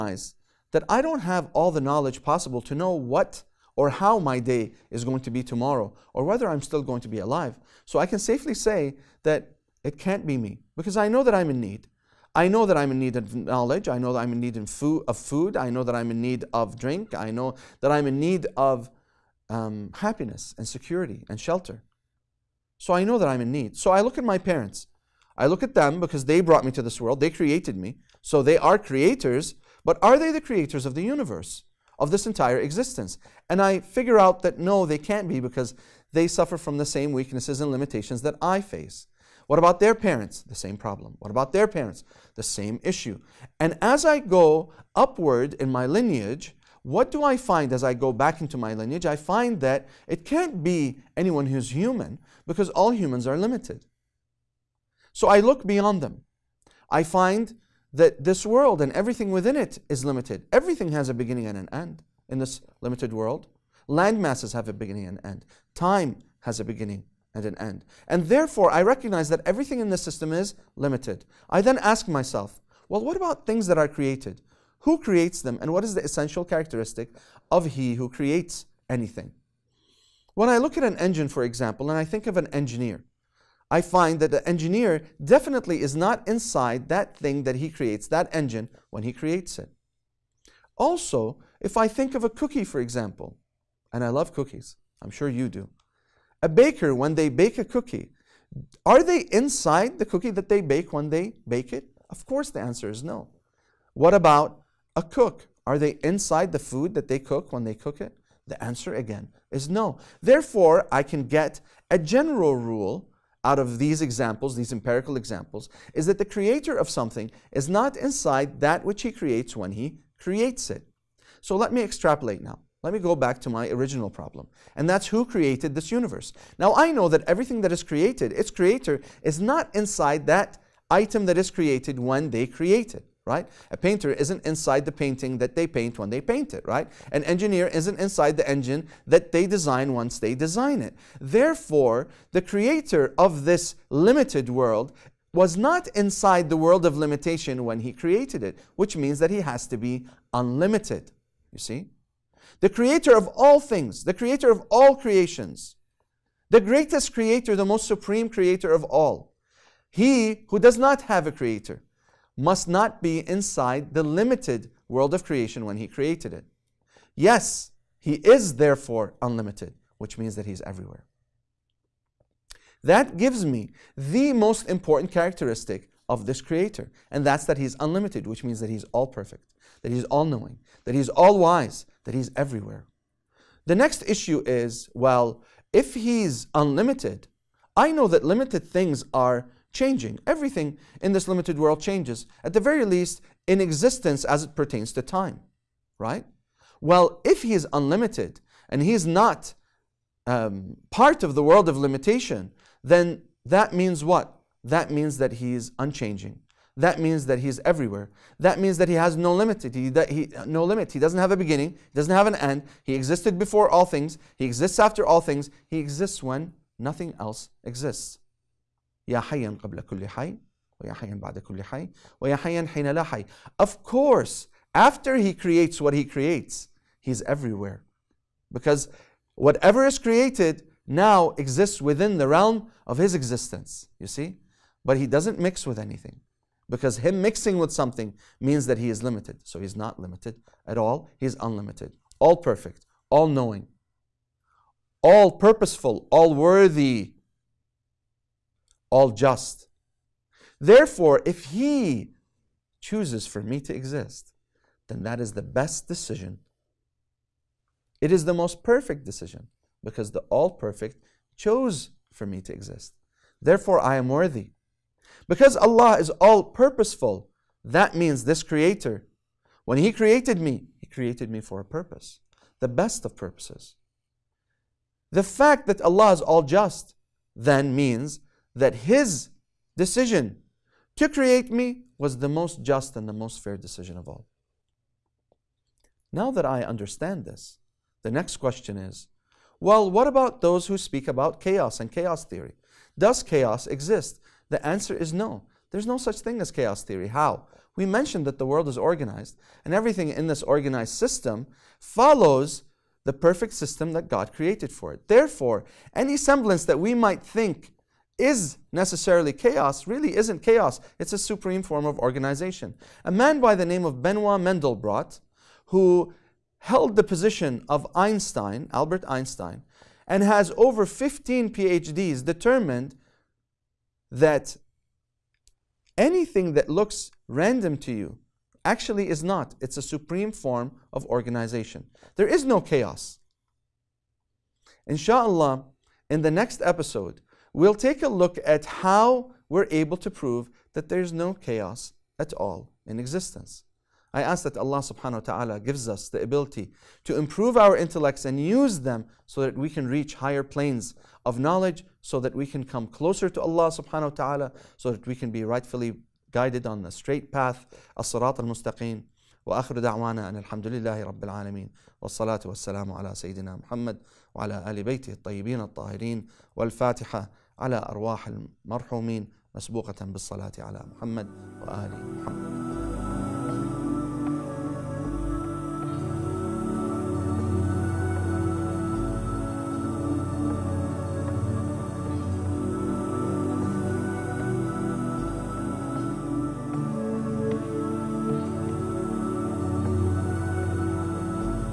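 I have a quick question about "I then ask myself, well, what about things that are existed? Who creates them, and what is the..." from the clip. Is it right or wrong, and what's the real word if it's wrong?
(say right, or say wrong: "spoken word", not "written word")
wrong: "created", not "existed".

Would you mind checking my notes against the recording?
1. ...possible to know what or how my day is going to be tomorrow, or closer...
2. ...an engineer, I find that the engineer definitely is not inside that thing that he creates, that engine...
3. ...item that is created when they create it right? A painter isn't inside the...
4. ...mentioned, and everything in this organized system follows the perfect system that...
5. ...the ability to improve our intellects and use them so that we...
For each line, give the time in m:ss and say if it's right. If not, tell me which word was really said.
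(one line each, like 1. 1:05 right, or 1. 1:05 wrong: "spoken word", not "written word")
1. 0:02 wrong: "whether", not "closer"
2. 1:22 right
3. 2:10 right
4. 4:58 wrong: "organized", not "mentioned"
5. 5:46 right.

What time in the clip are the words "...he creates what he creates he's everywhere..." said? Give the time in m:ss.
3:45.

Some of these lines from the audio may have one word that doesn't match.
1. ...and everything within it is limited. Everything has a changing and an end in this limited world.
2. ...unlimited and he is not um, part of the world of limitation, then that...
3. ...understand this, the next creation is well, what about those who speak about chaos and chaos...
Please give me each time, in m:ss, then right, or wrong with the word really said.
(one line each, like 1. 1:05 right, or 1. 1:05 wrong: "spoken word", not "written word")
1. 0:58 wrong: "beginning", not "changing"
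2. 3:17 right
3. 4:46 wrong: "question", not "creation".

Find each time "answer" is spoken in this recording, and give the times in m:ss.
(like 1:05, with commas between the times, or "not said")
1:42, 1:48, 4:54.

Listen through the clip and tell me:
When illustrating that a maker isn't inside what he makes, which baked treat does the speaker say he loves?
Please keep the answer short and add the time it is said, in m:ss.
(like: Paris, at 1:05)
Cookies, at 1:34.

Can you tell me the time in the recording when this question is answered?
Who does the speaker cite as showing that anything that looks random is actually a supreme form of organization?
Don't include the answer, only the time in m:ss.
5:14.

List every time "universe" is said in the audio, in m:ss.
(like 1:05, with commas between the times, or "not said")
0:31, 2:05.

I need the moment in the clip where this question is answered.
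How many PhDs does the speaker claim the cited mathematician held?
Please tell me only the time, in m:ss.
5:20.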